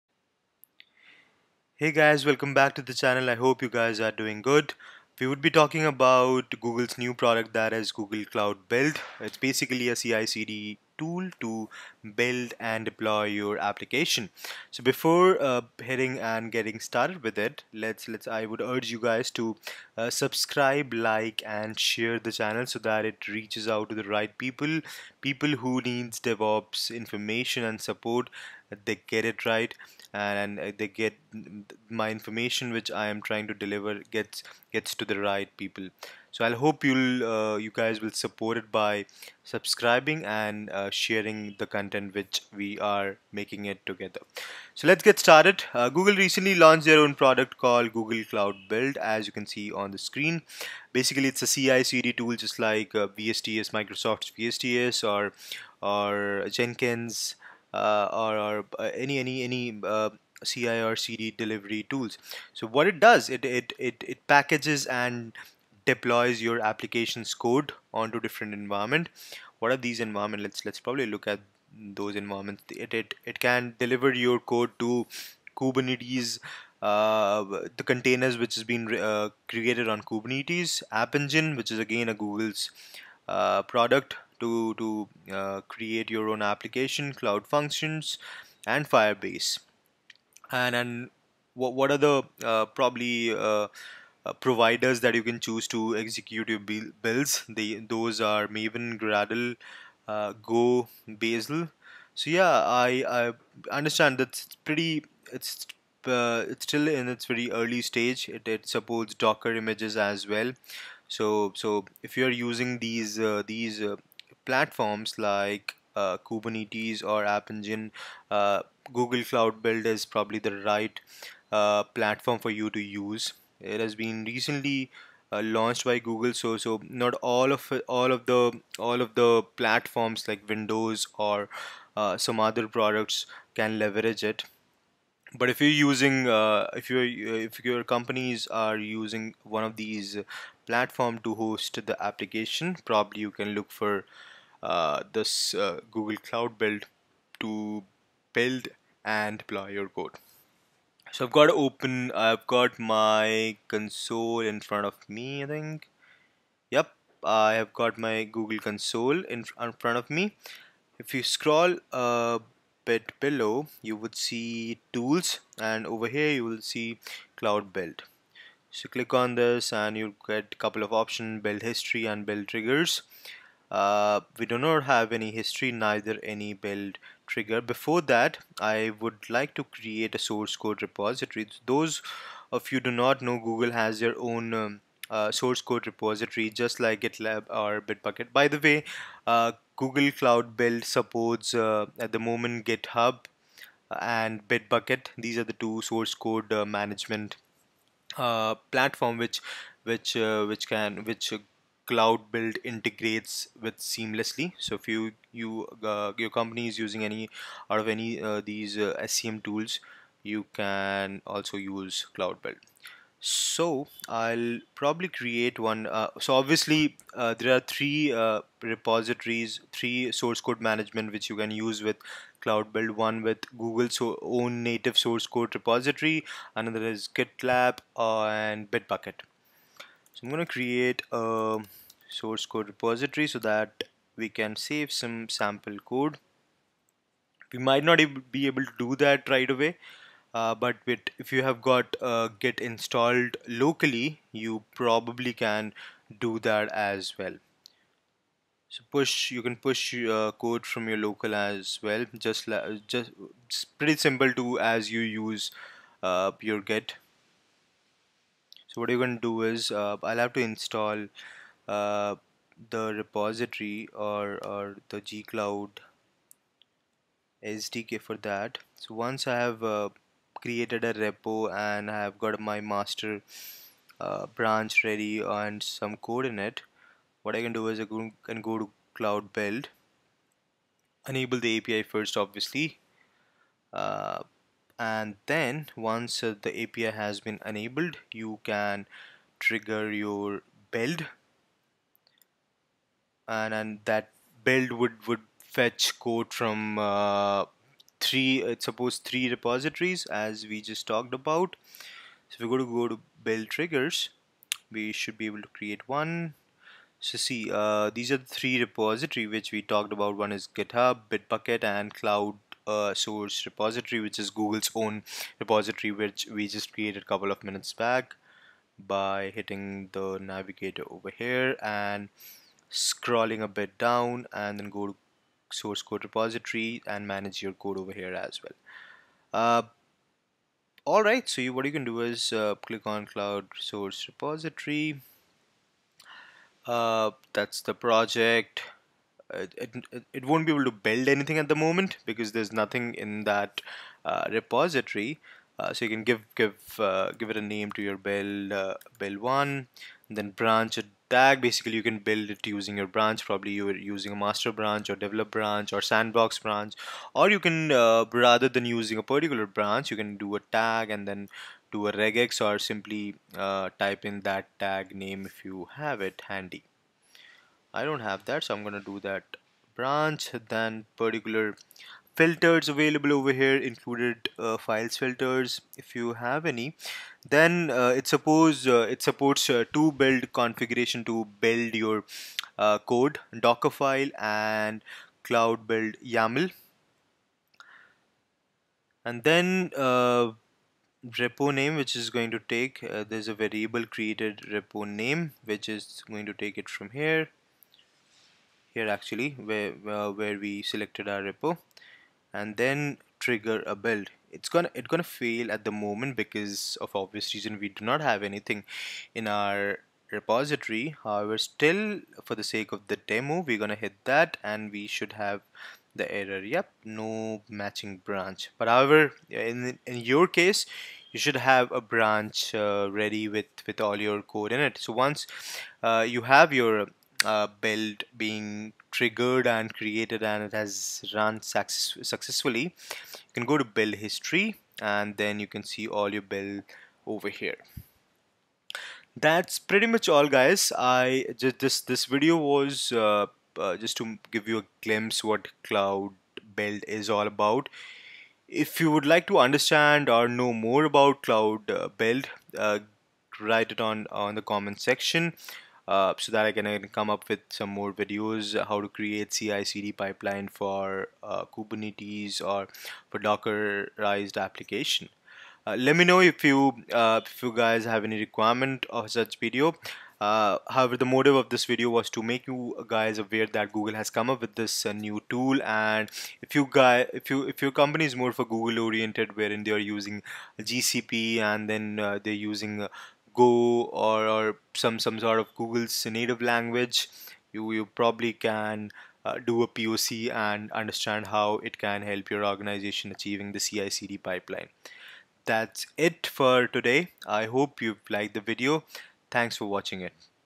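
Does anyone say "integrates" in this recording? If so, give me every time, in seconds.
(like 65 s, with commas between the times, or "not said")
202 s.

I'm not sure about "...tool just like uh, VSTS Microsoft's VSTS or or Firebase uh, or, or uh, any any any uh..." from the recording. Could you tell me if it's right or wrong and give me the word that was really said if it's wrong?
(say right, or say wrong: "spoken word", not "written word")
wrong: "Jenkins", not "Firebase".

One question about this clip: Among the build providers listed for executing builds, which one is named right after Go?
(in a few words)
Bazel.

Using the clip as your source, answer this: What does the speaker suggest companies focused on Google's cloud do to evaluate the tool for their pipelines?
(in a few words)
a POC.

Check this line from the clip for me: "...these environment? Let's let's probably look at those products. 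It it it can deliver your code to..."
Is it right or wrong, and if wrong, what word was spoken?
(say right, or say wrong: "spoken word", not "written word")
wrong: "environments", not "products".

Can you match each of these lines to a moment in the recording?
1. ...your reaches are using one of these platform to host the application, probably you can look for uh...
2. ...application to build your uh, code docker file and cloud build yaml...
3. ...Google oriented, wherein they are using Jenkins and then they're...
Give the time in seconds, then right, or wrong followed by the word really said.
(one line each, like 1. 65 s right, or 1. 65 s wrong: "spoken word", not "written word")
1. 137 s wrong: "companies", not "reaches"
2. 380 s wrong: "configuration", not "application"
3. 478 s wrong: "GCP", not "Jenkins".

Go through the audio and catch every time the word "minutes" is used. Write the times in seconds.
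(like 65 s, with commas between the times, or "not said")
317 s.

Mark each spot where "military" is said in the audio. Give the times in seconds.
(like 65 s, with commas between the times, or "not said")
not said.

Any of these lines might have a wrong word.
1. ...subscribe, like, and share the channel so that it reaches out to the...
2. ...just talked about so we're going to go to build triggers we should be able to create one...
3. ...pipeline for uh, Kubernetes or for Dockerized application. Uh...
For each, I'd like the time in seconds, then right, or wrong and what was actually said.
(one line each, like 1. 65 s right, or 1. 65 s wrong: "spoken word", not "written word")
1. 20 s right
2. 300 s right
3. 459 s right.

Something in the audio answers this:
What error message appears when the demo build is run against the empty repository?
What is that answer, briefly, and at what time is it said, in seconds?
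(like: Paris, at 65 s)
no matching branch, at 416 s.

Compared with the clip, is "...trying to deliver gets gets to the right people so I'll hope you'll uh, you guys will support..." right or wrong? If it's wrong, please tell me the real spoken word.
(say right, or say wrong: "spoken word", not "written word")
right.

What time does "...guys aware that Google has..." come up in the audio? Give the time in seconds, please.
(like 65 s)
472 s.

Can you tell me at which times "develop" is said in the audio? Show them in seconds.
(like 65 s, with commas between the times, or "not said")
355 s.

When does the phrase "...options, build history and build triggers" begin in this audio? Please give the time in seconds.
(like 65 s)
170 s.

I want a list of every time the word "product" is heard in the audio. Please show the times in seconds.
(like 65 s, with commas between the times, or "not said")
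7 s, 47 s, 83 s, 132 s.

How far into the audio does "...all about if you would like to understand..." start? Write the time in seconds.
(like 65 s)
447 s.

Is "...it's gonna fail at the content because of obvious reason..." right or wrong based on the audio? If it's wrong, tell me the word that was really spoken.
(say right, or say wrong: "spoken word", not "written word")
wrong: "moment", not "content".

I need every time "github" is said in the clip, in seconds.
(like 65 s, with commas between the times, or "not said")
192 s, 310 s.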